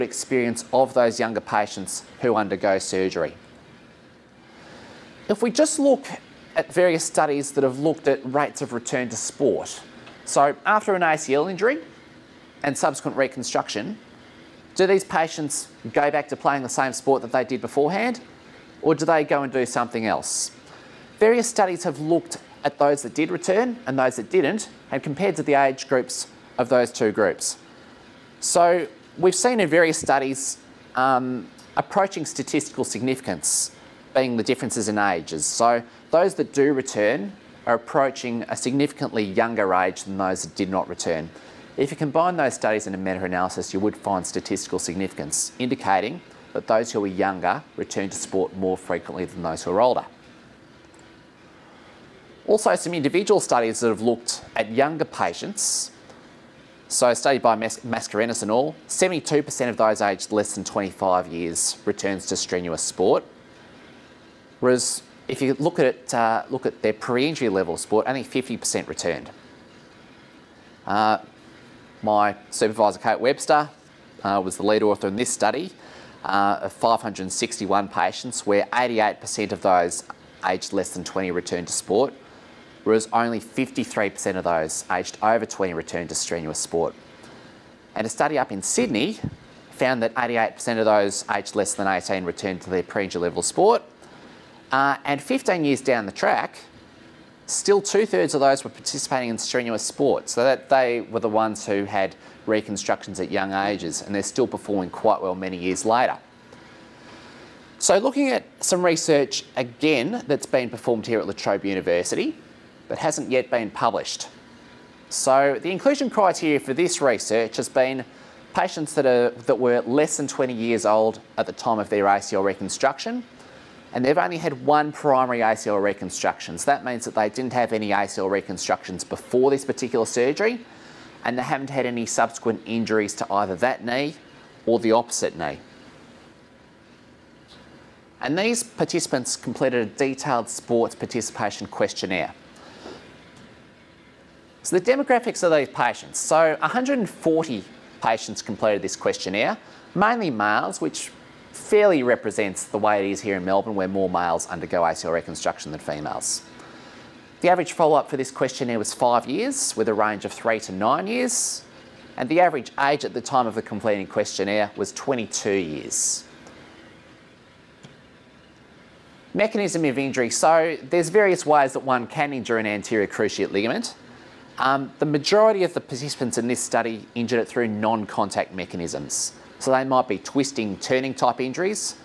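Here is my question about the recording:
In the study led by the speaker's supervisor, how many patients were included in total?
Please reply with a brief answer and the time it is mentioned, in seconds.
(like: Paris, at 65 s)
561, at 76 s.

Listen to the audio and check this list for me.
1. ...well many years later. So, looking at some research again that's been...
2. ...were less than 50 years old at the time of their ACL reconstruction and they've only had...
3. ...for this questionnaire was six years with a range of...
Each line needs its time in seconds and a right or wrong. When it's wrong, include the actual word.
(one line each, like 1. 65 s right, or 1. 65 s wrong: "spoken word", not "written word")
1. 105 s right
2. 119 s wrong: "20", not "50"
3. 158 s wrong: "five", not "six".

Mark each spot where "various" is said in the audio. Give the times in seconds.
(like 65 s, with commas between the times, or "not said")
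6 s, 21 s, 29 s, 171 s.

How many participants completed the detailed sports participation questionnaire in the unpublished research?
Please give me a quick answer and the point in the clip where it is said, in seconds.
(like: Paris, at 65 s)
140, at 146 s.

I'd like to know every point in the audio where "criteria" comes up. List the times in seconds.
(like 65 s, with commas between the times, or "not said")
116 s.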